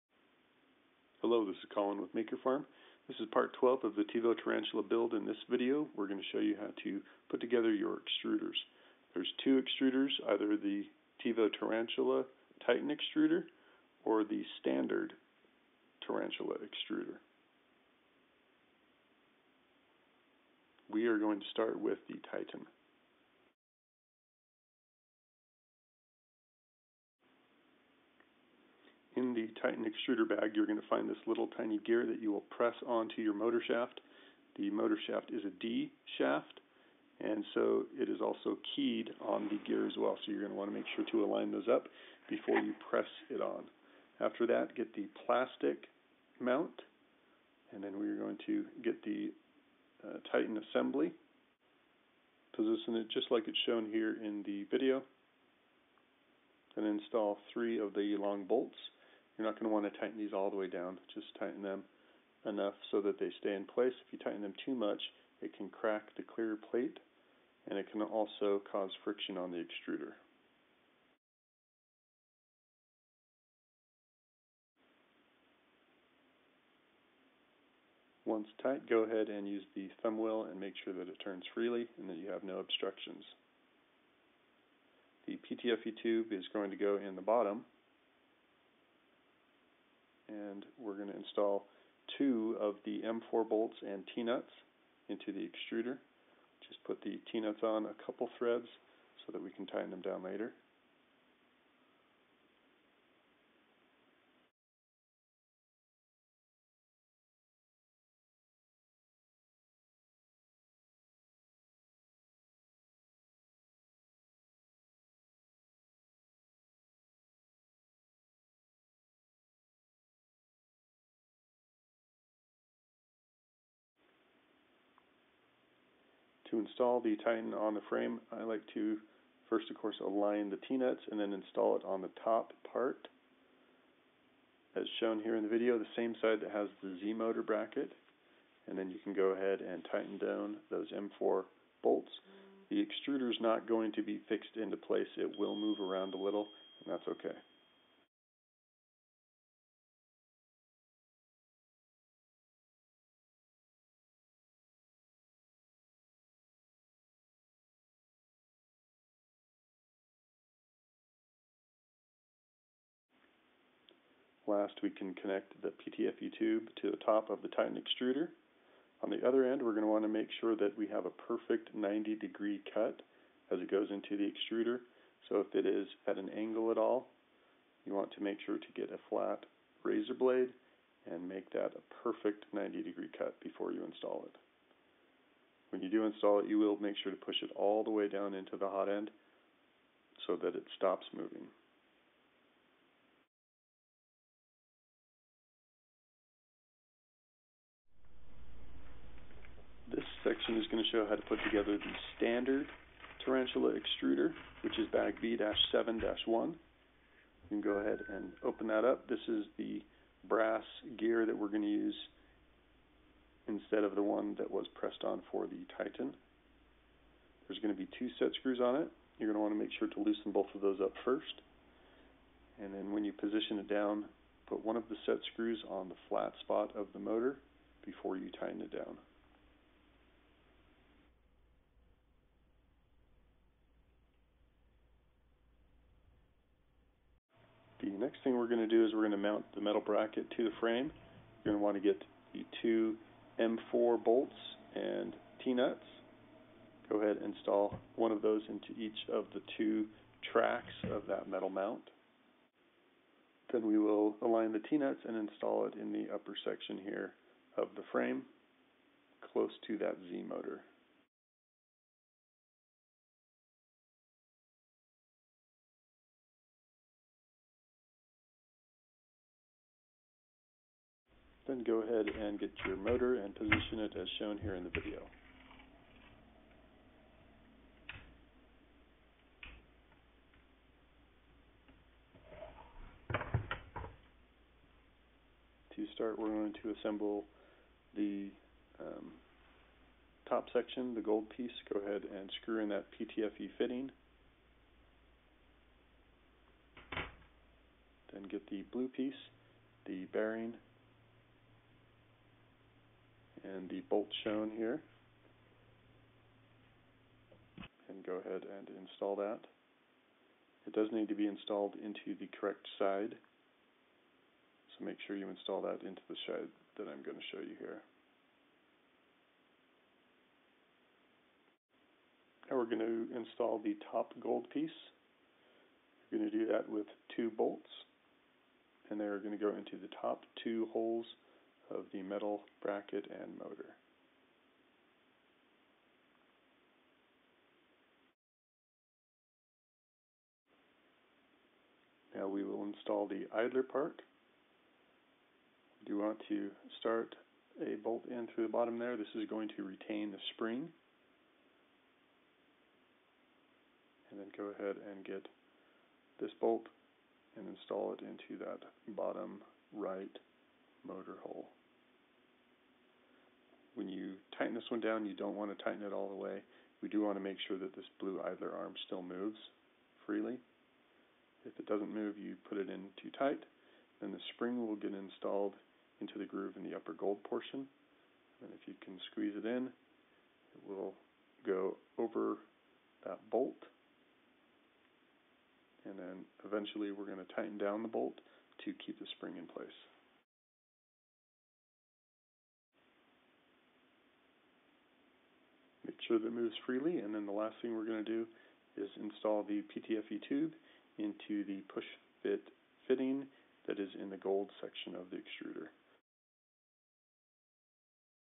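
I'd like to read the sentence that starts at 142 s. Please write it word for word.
The extruder is not going to be fixed into place.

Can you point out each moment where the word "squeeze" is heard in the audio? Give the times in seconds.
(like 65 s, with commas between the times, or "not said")
379 s.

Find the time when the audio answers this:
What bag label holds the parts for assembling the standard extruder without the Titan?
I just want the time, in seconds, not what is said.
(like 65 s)
205 s.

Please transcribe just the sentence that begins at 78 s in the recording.
Once tight, go ahead and use the thumb wheel and make sure that it turns freely and that you have no obstructions.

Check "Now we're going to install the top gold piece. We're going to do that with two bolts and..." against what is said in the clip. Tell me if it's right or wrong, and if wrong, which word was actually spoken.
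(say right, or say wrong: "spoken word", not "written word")
right.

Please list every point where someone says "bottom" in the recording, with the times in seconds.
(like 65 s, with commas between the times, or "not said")
87 s, 348 s, 358 s.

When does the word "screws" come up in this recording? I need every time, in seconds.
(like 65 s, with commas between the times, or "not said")
218 s, 225 s, 292 s.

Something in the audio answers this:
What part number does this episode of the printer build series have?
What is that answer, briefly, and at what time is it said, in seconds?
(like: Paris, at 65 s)
12, at 3 s.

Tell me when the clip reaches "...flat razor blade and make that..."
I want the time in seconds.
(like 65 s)
179 s.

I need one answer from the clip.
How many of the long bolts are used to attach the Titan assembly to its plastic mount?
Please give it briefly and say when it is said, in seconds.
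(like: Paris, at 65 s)
3, at 57 s.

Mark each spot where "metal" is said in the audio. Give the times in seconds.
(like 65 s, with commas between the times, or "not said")
239 s, 251 s, 332 s.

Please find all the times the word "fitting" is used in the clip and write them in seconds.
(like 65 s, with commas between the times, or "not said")
293 s, 402 s.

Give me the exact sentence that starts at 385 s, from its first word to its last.
And then eventually we're going to tighten down the bolt to keep the spring in place.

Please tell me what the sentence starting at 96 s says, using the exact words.
Just put the T-nuts on a couple threads so that we can tighten them down later.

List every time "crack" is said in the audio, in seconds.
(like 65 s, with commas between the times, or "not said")
65 s.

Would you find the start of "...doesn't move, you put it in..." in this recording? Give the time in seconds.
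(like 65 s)
371 s.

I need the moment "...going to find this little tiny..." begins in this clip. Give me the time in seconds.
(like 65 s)
30 s.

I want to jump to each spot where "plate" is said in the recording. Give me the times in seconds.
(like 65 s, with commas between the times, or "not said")
66 s.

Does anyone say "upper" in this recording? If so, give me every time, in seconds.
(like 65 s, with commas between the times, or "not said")
256 s, 376 s.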